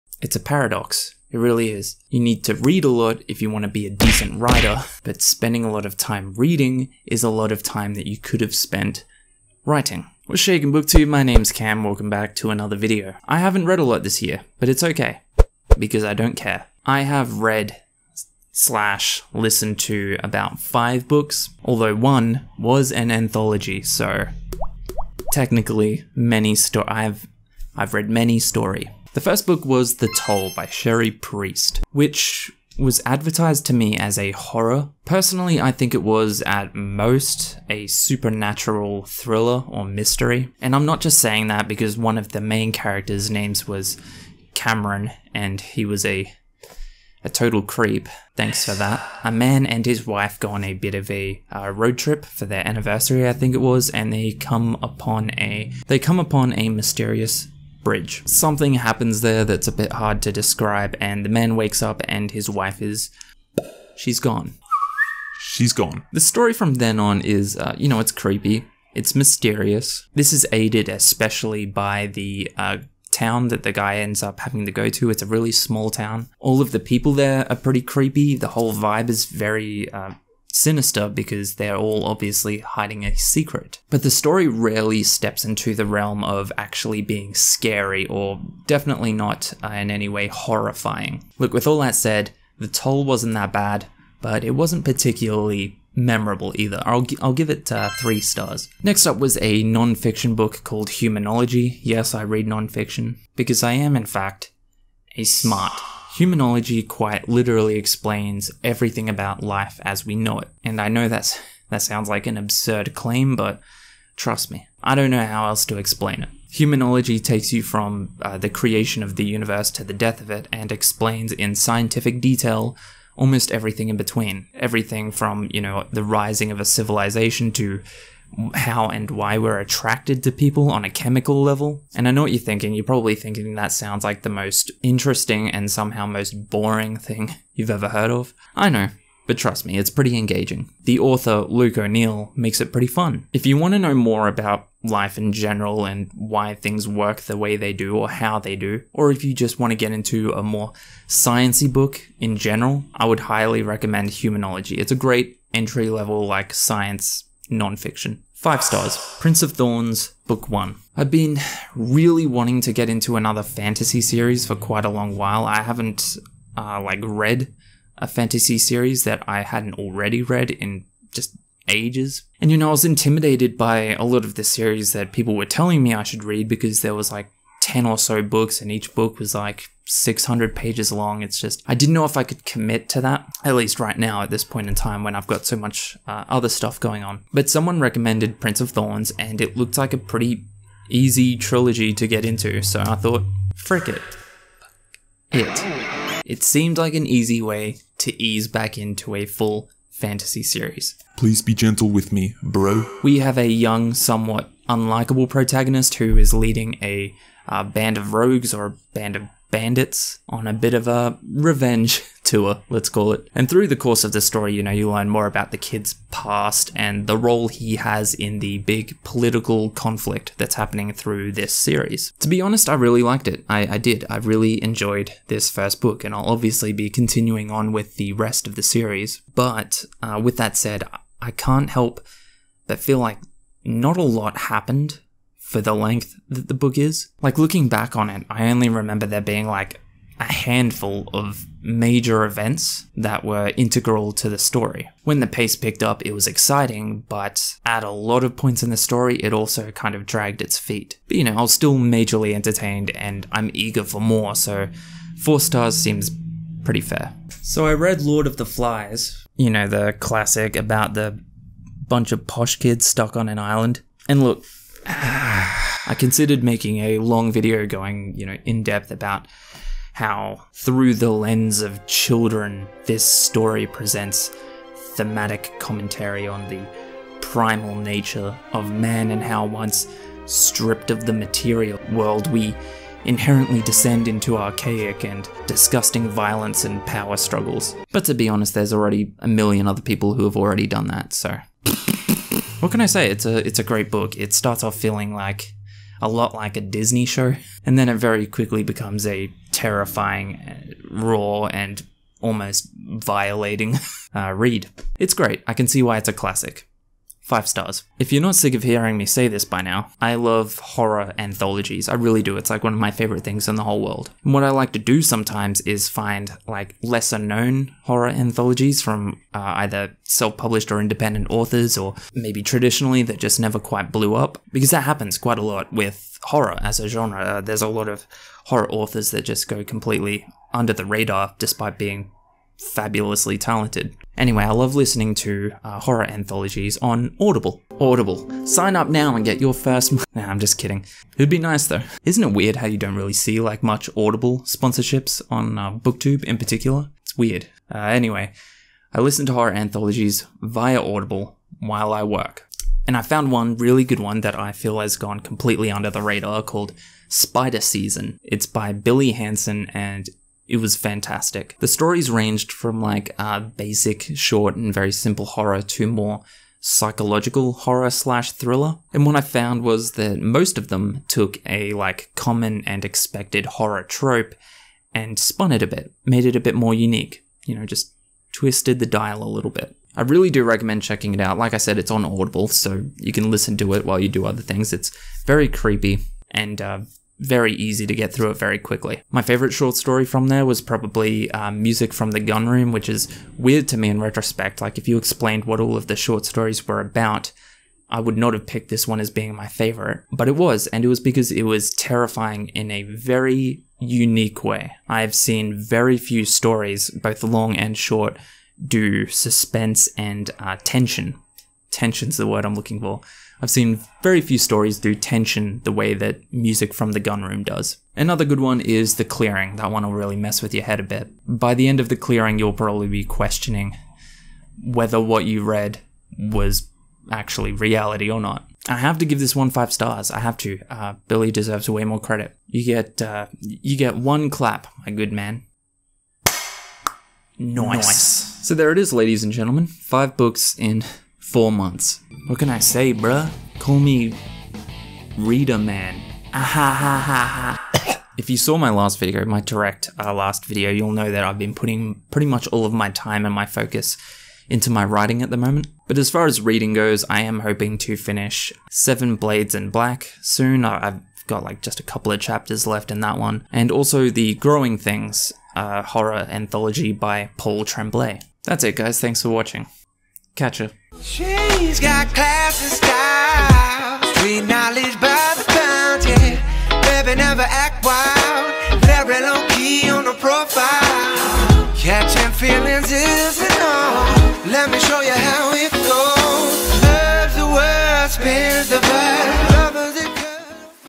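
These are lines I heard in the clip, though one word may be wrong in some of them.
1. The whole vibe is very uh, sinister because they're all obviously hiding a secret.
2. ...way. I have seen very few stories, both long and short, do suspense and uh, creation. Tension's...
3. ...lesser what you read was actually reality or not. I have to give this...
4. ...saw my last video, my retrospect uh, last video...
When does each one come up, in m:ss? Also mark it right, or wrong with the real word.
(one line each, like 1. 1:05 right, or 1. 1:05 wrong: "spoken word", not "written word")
1. 1:18 right
2. 6:44 wrong: "tension", not "creation"
3. 7:04 wrong: "whether", not "lesser"
4. 7:28 wrong: "direct", not "retrospect".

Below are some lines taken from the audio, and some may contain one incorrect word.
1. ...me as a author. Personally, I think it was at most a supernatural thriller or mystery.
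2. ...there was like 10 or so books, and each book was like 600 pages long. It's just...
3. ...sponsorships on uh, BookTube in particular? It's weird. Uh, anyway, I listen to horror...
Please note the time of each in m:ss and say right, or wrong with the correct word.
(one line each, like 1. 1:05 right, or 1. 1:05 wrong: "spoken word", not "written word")
1. 0:33 wrong: "horror", not "author"
2. 2:56 right
3. 5:44 right.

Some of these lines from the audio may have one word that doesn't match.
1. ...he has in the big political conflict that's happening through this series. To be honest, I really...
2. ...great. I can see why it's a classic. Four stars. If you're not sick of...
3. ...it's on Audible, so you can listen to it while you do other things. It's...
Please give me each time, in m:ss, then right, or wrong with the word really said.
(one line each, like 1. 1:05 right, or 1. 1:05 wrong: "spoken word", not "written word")
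1. 3:37 right
2. 5:05 wrong: "Five", not "Four"
3. 6:21 right.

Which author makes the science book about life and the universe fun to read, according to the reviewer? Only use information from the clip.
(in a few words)
Luke O'Neill.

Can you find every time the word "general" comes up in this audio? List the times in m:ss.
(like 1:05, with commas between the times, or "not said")
2:25, 2:32.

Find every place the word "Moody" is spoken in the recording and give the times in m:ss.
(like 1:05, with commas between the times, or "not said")
not said.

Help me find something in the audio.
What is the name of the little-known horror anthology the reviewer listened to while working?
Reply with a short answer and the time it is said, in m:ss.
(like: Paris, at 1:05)
Spider Season, at 5:57.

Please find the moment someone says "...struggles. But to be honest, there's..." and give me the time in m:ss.
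4:47.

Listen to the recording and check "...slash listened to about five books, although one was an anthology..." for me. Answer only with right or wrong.
right.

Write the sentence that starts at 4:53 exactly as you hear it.
It's a it's a great book.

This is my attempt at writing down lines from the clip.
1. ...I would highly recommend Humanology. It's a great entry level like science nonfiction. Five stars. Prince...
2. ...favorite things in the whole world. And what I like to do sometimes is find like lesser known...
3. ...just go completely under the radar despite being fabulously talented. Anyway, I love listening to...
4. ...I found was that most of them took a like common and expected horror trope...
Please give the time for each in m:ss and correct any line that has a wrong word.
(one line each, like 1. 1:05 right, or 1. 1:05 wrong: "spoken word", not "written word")
1. 2:32 right
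2. 5:12 right
3. 5:29 right
4. 6:09 right.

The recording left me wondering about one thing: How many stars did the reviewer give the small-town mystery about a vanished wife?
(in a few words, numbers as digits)
3.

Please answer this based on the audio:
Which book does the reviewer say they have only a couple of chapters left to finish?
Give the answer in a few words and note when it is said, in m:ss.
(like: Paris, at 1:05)
Seven Blades in Black, at 7:38.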